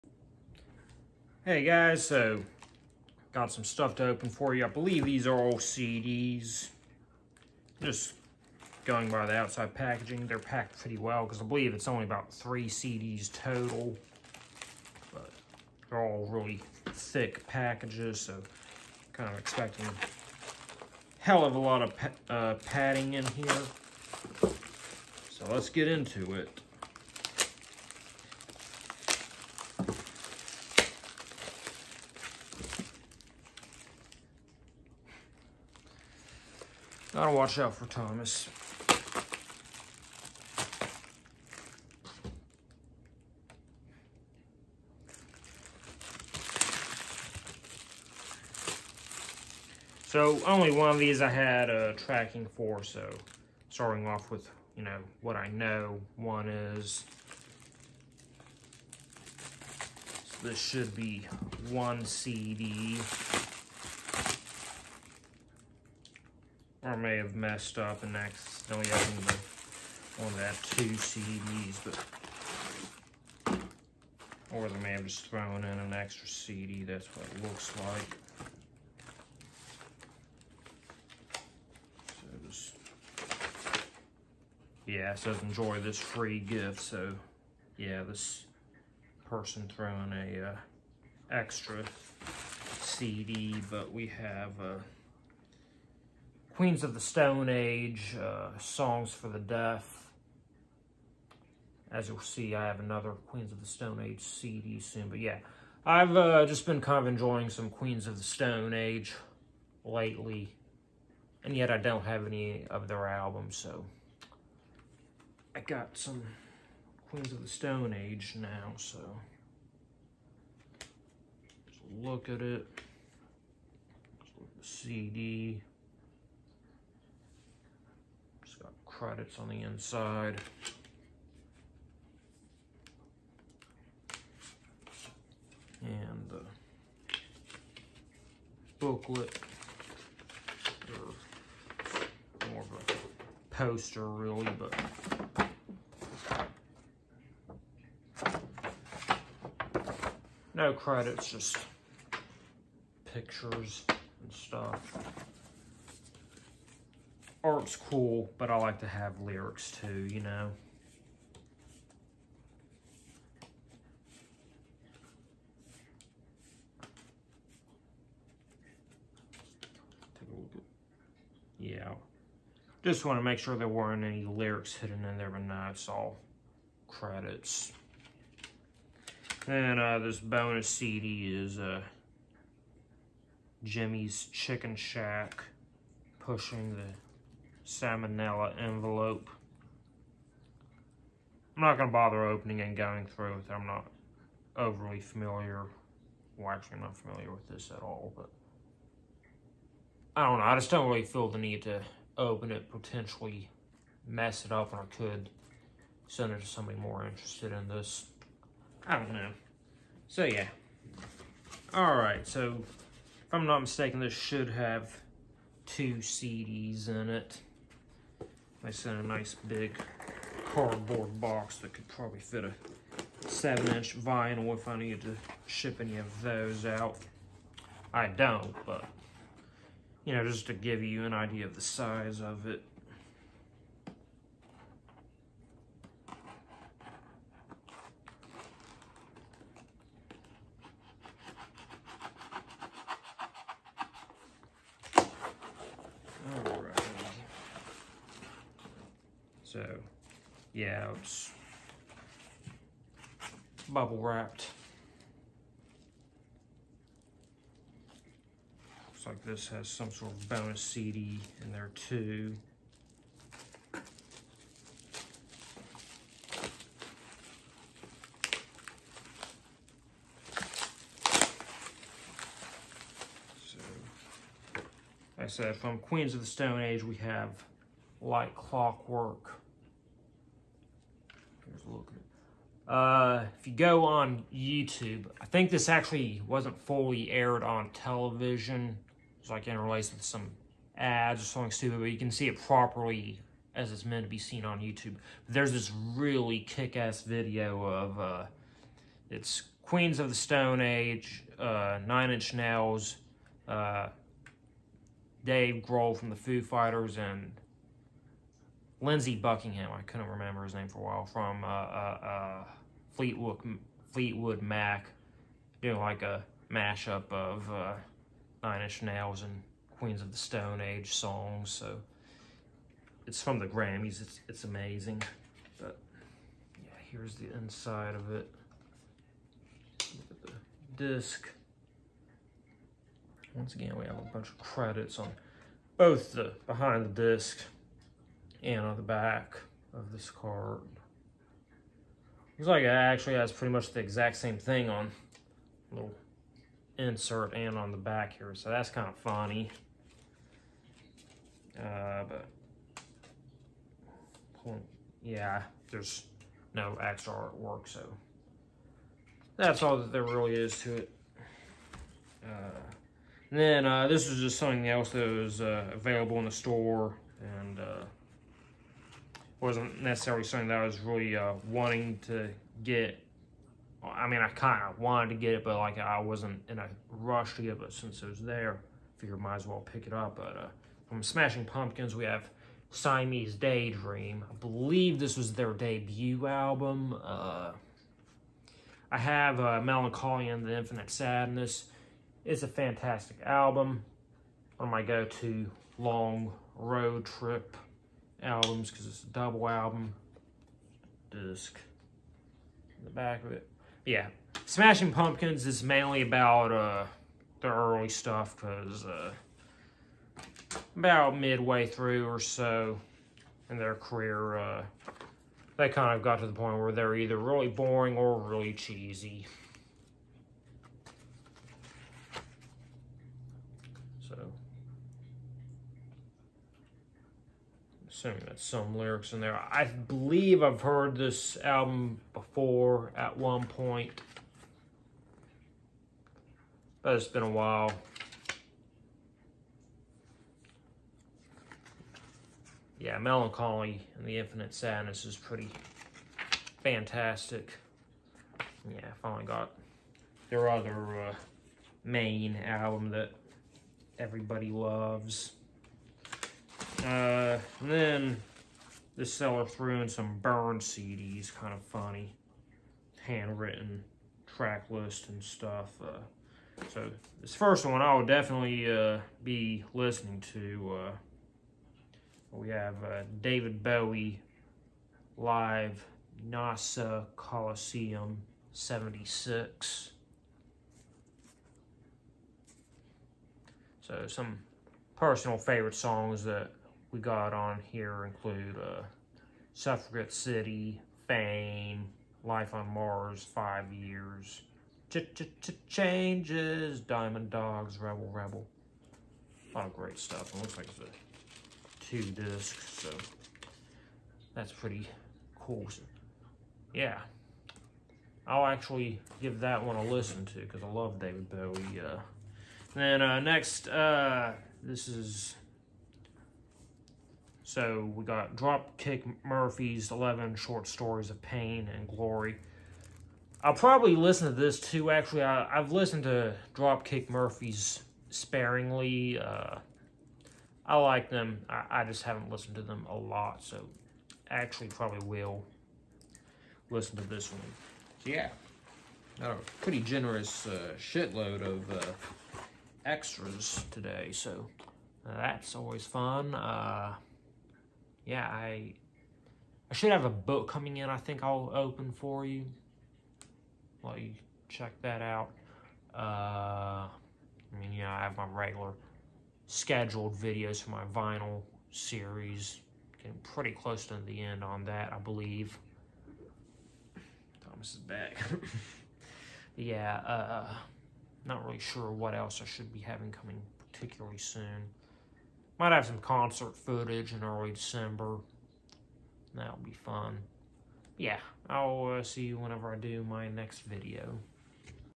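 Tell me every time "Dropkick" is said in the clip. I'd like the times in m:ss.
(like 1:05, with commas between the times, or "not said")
8:38, 8:46.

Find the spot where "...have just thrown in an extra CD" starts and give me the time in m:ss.
1:14.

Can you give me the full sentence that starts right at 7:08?
assuming that's some lyrics in there.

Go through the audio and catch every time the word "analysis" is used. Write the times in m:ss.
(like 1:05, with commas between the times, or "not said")
not said.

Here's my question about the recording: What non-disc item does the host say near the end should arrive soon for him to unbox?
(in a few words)
A book.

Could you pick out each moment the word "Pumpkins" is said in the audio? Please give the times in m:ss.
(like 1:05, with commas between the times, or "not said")
6:21, 6:44.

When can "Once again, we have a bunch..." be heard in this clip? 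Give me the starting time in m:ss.
5:33.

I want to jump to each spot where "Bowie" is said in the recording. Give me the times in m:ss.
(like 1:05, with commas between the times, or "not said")
7:53, 8:31.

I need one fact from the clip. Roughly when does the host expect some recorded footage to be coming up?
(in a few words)
Early December.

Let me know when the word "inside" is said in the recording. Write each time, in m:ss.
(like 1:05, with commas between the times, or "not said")
2:09, 5:27.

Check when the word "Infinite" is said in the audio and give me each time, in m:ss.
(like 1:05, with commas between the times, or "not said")
6:30, 7:24.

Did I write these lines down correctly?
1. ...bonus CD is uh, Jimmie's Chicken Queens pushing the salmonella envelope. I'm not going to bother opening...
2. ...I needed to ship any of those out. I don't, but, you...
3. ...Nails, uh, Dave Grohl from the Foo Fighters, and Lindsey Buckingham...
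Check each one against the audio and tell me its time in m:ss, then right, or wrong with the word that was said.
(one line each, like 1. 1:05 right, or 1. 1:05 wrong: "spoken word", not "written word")
1. 3:00 wrong: "Shack", not "Queens"
2. 3:44 right
3. 5:02 right.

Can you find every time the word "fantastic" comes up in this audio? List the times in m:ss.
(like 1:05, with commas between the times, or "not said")
6:32, 7:26.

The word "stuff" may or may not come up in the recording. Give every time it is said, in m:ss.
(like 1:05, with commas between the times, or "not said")
0:03, 2:34, 6:47, 7:45, 8:19.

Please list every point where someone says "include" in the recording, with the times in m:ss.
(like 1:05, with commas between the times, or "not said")
8:08.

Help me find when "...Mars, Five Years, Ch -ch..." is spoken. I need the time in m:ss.
8:12.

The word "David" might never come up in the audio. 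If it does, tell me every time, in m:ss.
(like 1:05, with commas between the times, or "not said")
7:53, 8:30.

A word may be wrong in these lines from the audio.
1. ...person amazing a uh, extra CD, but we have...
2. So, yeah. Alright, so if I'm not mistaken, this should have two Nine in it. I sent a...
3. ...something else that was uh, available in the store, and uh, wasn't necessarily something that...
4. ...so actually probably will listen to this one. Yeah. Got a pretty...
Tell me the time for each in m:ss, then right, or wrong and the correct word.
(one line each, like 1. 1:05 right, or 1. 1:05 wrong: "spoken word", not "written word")
1. 1:29 wrong: "throwing", not "amazing"
2. 3:30 wrong: "CDs", not "Nine"
3. 6:04 right
4. 8:53 right.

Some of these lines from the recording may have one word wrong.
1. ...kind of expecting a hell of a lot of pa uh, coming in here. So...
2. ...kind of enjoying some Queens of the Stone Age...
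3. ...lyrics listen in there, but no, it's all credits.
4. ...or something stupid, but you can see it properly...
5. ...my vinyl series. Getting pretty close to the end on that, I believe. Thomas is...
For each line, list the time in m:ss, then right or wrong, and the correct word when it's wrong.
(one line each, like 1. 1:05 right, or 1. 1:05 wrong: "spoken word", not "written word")
1. 0:19 wrong: "padding", not "coming"
2. 1:46 right
3. 2:54 wrong: "hidden", not "listen"
4. 4:51 right
5. 9:20 right.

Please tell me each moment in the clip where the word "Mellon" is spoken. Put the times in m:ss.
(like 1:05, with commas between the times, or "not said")
6:29, 7:22.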